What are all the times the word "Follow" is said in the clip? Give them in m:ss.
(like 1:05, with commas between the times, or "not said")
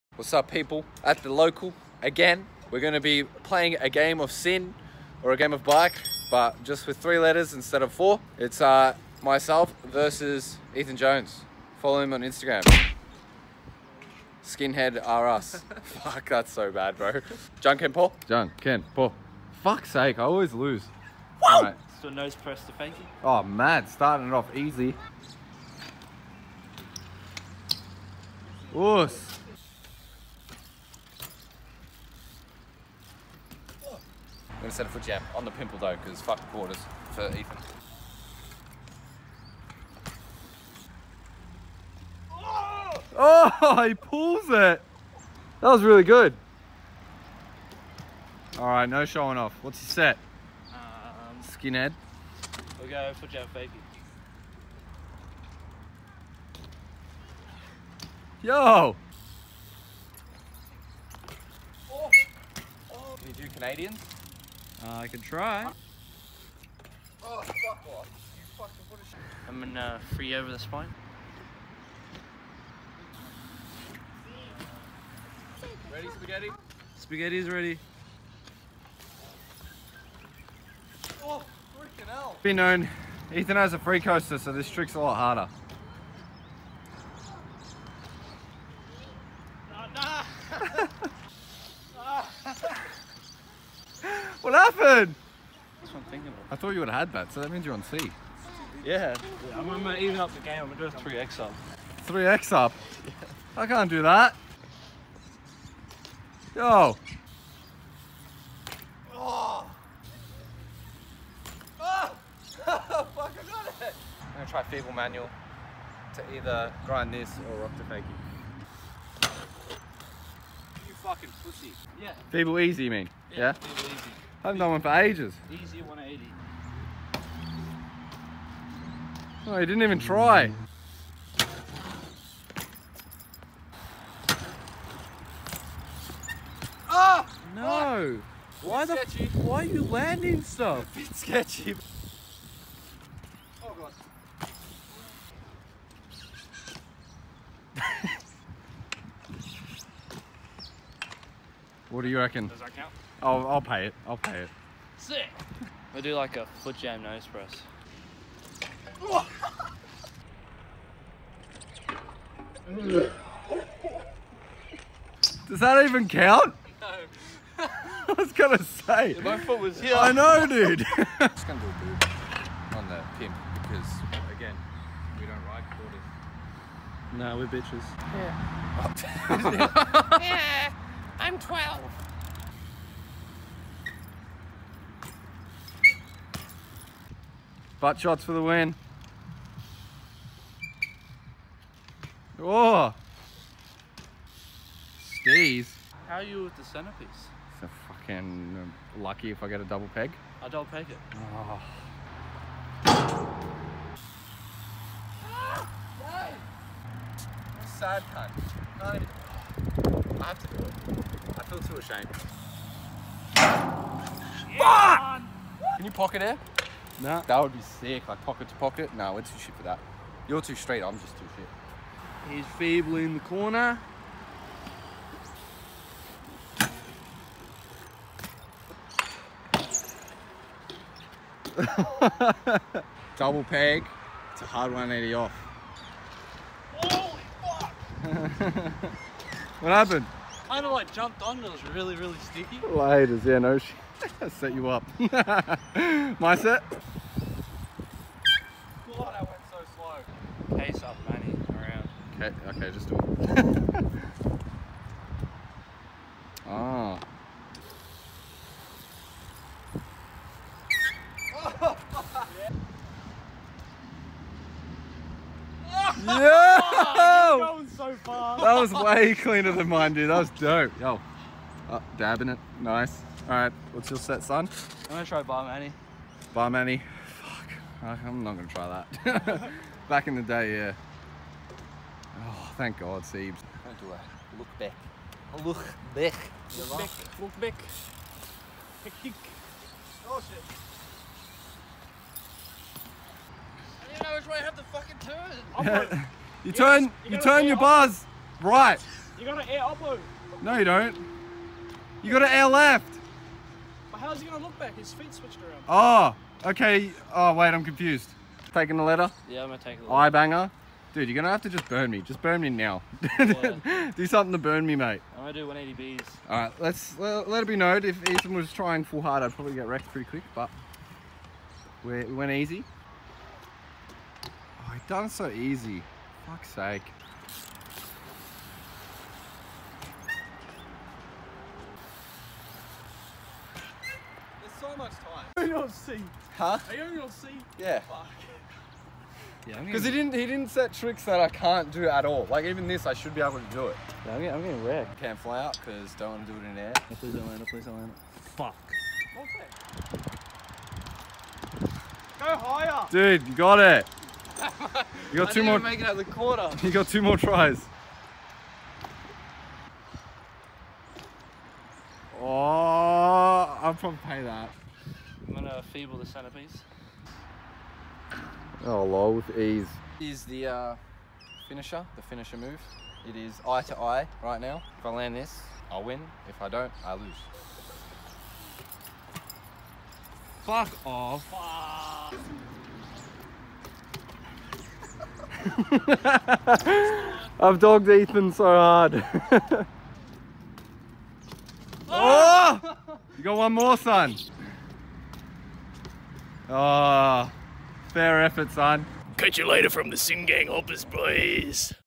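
0:11.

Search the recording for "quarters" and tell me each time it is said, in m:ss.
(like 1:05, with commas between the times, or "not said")
0:36, 2:55, 5:56.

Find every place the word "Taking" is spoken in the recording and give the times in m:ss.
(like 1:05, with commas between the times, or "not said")
5:08.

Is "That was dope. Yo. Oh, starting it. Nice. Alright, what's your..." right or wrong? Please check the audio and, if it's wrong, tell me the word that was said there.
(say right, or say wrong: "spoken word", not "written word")
wrong: "dabbing", not "starting".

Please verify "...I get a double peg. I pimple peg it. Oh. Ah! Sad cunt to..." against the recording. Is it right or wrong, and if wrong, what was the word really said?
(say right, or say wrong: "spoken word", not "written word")
wrong: "double", not "pimple".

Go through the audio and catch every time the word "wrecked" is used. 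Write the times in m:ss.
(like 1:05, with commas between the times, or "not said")
5:19, 5:44.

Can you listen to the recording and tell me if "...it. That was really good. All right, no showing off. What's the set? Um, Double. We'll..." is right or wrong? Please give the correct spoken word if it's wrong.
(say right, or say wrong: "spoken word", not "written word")
wrong: "Skinhead", not "Double".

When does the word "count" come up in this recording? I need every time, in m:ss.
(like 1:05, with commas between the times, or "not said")
2:32, 2:46.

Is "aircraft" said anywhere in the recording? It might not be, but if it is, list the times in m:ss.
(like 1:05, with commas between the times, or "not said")
not said.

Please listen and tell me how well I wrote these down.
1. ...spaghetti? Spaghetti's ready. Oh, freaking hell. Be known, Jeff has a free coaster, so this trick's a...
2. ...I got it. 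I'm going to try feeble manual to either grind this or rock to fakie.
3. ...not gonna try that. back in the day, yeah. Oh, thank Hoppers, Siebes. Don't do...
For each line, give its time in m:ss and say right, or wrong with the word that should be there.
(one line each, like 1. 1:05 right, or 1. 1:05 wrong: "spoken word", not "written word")
1. 1:16 wrong: "Ethan", not "Jeff"
2. 1:52 right
3. 4:38 wrong: "God", not "Hoppers".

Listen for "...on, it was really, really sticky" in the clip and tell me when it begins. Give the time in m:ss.
4:01.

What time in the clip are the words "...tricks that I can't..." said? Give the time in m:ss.
5:40.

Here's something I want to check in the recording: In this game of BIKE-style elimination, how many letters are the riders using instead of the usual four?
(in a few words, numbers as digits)
3.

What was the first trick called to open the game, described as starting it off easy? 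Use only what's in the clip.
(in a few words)
Nose press to fakie.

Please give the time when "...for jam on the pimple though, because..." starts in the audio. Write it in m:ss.
0:34.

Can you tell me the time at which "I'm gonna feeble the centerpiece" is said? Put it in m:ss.
6:05.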